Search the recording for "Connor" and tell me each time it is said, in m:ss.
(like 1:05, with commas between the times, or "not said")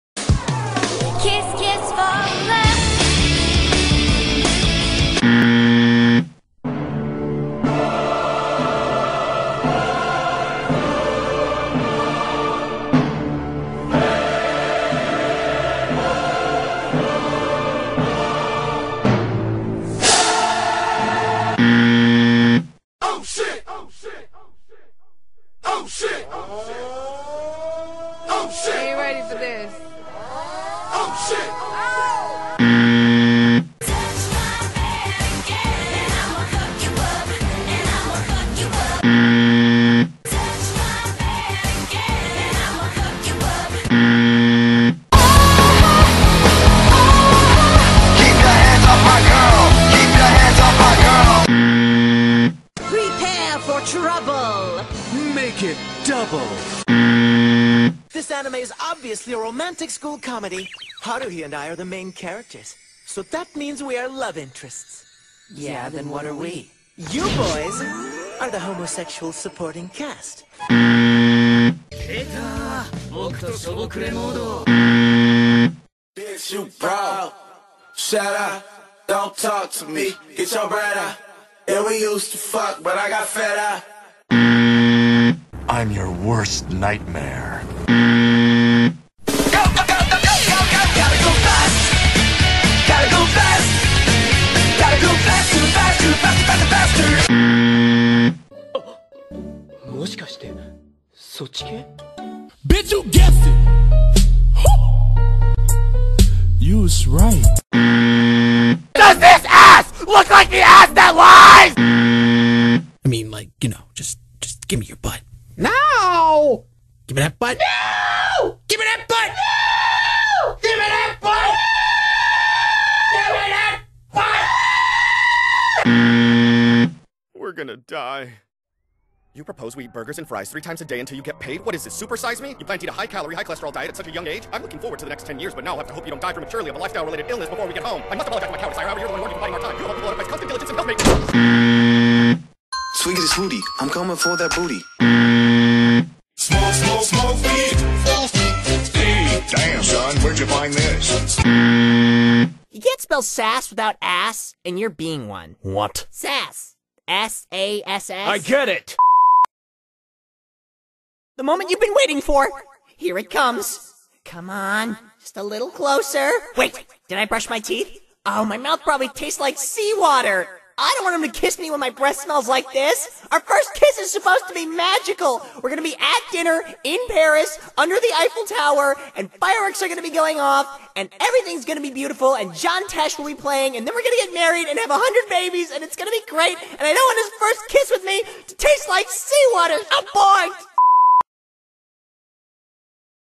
not said.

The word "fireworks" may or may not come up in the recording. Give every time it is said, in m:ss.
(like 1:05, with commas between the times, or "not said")
2:59.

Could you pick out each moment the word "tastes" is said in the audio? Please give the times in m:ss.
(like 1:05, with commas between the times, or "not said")
2:49, 3:08.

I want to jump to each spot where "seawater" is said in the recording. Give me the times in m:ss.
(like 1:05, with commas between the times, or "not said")
2:49, 3:09.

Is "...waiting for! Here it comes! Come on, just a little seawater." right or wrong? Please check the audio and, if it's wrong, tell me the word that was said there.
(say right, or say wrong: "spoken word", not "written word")
wrong: "closer", not "seawater".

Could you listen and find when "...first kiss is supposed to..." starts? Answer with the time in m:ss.
2:53.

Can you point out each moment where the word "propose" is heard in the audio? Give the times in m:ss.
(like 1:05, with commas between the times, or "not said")
2:09.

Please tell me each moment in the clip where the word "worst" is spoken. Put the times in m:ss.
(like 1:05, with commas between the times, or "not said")
1:26.